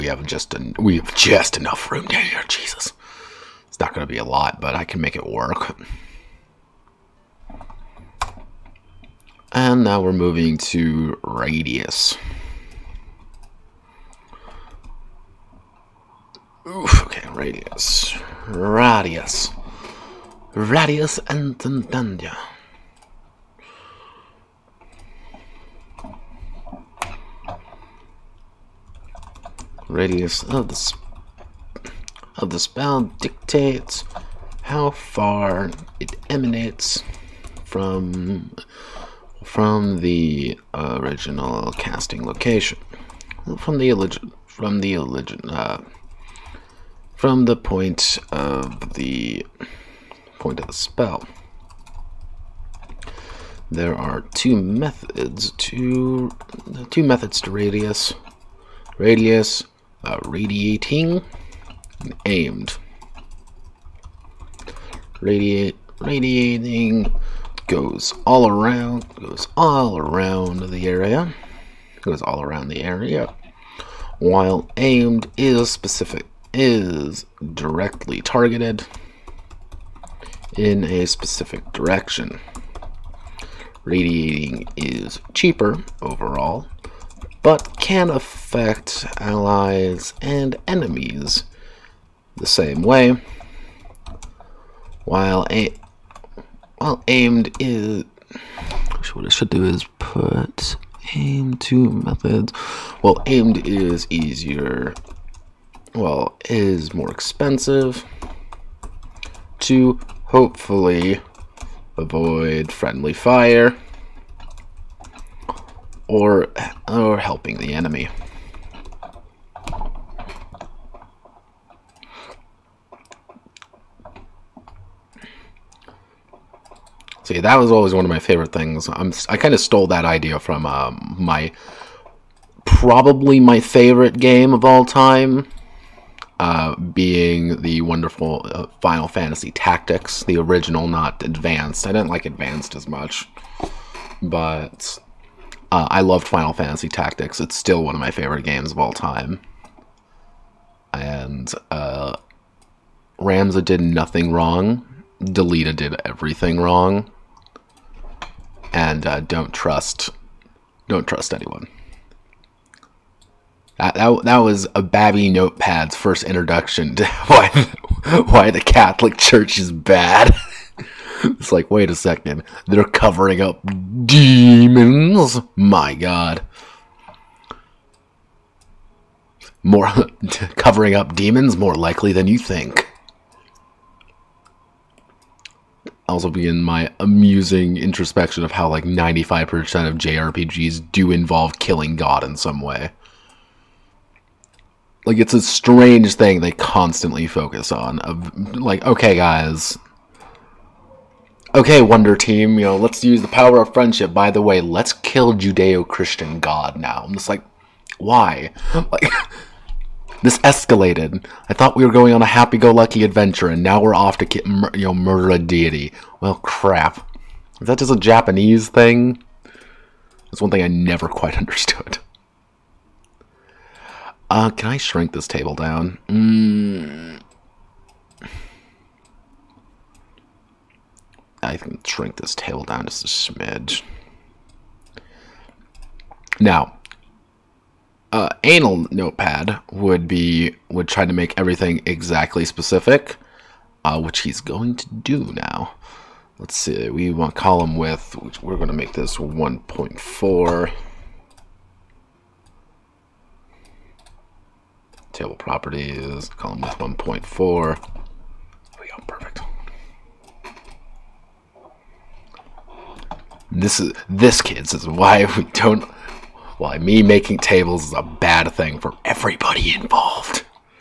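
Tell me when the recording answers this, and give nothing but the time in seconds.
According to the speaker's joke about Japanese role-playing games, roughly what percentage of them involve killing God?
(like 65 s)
188 s.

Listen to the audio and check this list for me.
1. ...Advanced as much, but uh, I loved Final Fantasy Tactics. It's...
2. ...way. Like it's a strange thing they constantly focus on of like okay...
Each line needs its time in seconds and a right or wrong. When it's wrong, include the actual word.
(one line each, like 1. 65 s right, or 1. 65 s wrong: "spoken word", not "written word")
1. 142 s right
2. 192 s right.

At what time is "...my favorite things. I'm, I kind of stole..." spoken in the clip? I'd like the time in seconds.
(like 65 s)
128 s.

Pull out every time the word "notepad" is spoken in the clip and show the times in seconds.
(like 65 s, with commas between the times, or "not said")
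165 s, 238 s.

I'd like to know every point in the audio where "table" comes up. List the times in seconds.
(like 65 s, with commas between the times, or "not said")
225 s, 232 s, 255 s, 267 s.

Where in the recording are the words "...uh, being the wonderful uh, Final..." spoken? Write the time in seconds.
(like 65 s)
136 s.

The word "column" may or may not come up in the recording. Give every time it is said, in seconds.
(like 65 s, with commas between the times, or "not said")
247 s, 256 s.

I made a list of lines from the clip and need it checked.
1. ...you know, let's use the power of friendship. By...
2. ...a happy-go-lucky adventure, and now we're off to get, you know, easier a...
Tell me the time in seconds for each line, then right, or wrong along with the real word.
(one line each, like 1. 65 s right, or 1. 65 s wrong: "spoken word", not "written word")
1. 202 s right
2. 212 s wrong: "murder", not "easier".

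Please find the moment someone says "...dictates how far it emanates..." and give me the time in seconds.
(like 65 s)
33 s.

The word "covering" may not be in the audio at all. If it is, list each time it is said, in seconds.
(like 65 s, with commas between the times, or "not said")
172 s, 180 s.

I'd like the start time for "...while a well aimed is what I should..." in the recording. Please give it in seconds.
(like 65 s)
95 s.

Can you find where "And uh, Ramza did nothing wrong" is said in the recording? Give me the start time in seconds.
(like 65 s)
150 s.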